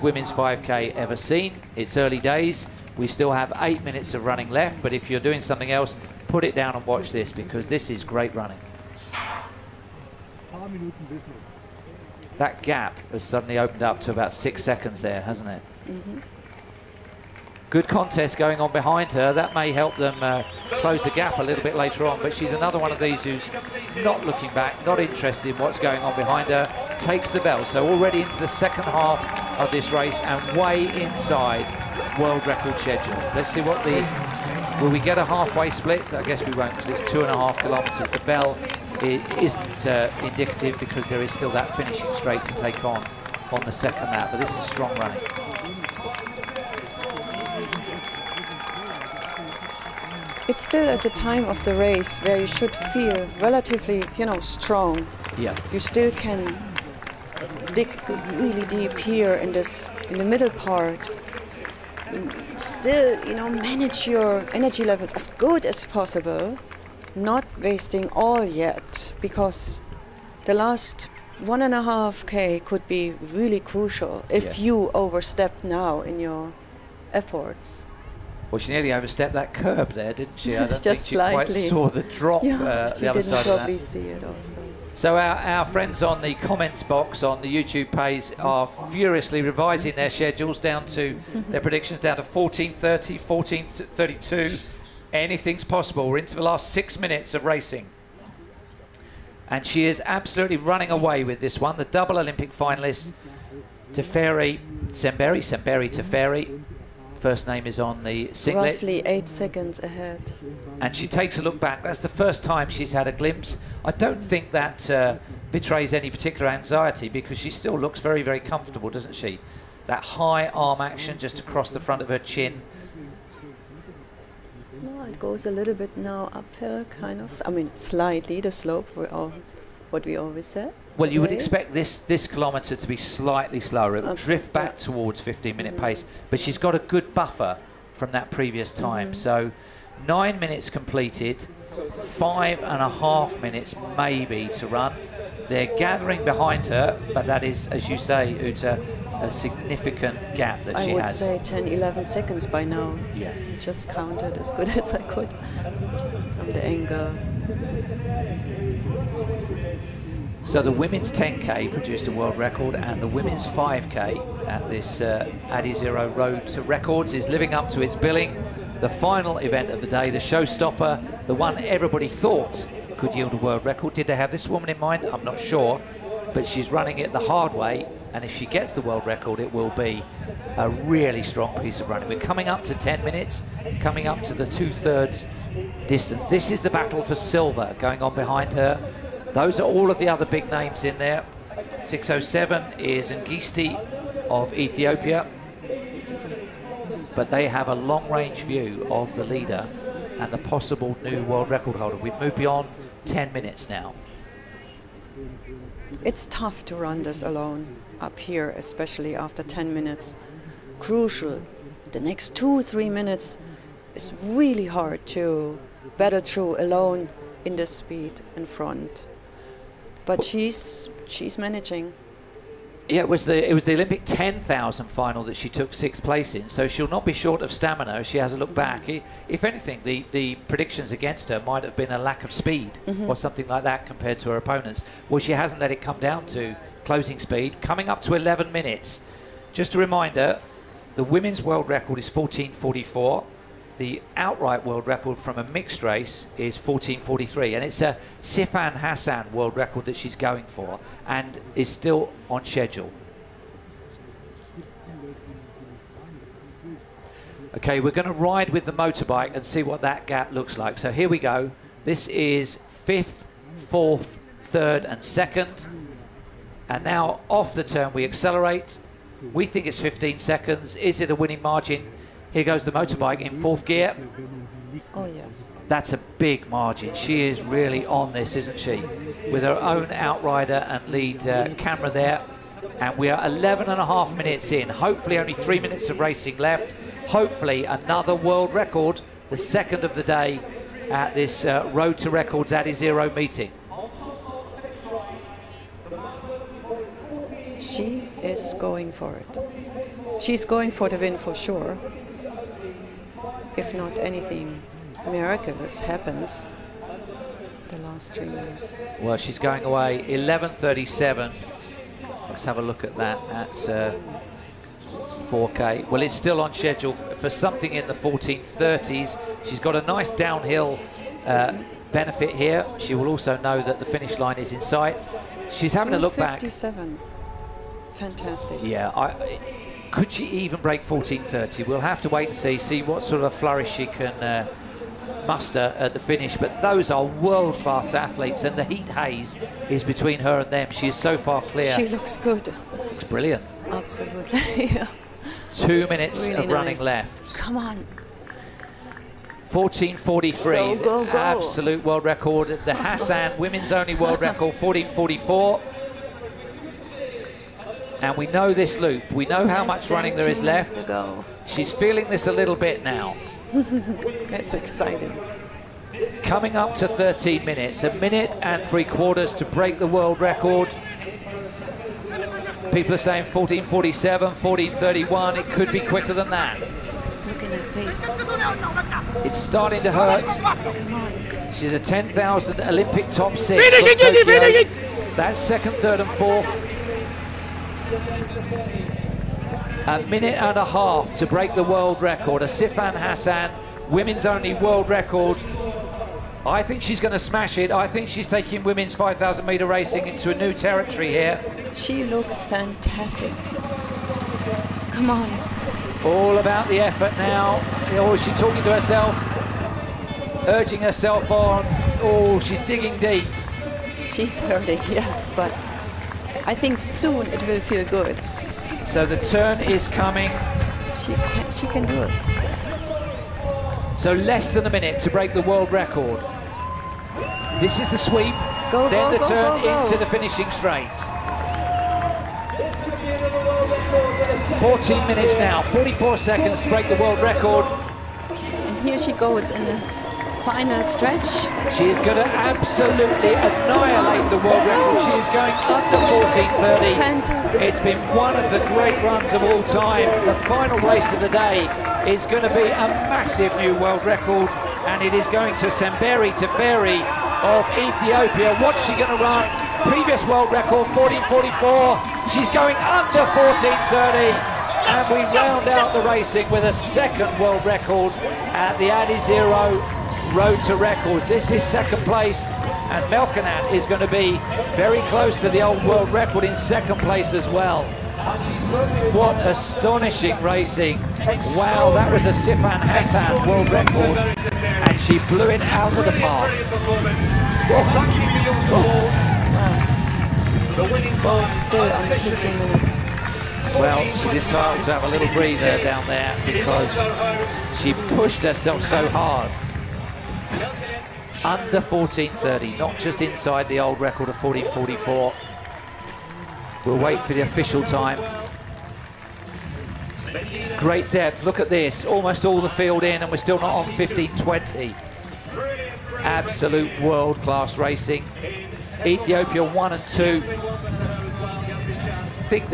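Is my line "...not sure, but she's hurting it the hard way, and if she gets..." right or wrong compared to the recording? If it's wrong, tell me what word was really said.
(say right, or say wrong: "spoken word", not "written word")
wrong: "running", not "hurting".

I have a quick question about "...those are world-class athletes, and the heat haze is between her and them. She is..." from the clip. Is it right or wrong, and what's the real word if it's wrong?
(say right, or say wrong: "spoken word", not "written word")
right.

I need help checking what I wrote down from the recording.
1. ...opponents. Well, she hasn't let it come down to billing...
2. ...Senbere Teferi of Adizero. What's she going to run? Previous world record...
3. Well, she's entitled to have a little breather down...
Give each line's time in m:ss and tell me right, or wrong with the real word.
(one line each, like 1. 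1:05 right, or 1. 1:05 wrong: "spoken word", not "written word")
1. 3:54 wrong: "closing", not "billing"
2. 7:35 wrong: "Ethiopia", not "Adizero"
3. 8:13 right.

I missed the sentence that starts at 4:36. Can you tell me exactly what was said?
She is really on this, isn't she?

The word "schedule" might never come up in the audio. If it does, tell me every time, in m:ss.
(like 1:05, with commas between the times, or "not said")
0:32, 1:30, 4:12, 5:16.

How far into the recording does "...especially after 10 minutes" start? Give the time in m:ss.
3:28.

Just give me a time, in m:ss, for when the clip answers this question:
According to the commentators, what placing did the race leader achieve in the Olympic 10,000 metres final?
3:45.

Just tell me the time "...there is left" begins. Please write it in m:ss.
6:00.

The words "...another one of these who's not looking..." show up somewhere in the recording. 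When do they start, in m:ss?
0:22.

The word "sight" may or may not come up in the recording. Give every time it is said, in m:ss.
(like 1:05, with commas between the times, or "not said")
5:24.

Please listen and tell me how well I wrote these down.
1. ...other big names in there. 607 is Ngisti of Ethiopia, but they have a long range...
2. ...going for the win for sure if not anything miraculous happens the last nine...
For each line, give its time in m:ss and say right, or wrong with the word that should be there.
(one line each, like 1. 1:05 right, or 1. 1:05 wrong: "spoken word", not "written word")
1. 3:10 right
2. 5:00 wrong: "three", not "nine".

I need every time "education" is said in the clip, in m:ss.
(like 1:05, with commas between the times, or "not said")
not said.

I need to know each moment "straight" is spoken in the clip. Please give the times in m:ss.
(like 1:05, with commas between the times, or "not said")
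0:42, 7:10.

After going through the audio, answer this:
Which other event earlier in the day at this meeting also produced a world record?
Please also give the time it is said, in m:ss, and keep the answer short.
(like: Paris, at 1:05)
Women's 10K, at 2:40.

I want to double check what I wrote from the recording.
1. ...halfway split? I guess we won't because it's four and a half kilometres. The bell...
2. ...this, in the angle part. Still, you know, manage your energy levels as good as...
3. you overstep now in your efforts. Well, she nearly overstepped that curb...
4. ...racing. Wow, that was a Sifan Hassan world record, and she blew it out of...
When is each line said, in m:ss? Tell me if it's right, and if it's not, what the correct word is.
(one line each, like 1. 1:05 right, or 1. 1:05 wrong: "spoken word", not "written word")
1. 0:35 wrong: "two", not "four"
2. 0:59 wrong: "middle", not "angle"
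3. 1:14 right
4. 8:00 right.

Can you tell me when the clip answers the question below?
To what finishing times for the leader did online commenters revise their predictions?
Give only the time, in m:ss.
1:32.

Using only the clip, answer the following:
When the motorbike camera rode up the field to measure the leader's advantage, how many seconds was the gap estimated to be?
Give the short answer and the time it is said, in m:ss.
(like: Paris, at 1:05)
15 seconds, at 4:29.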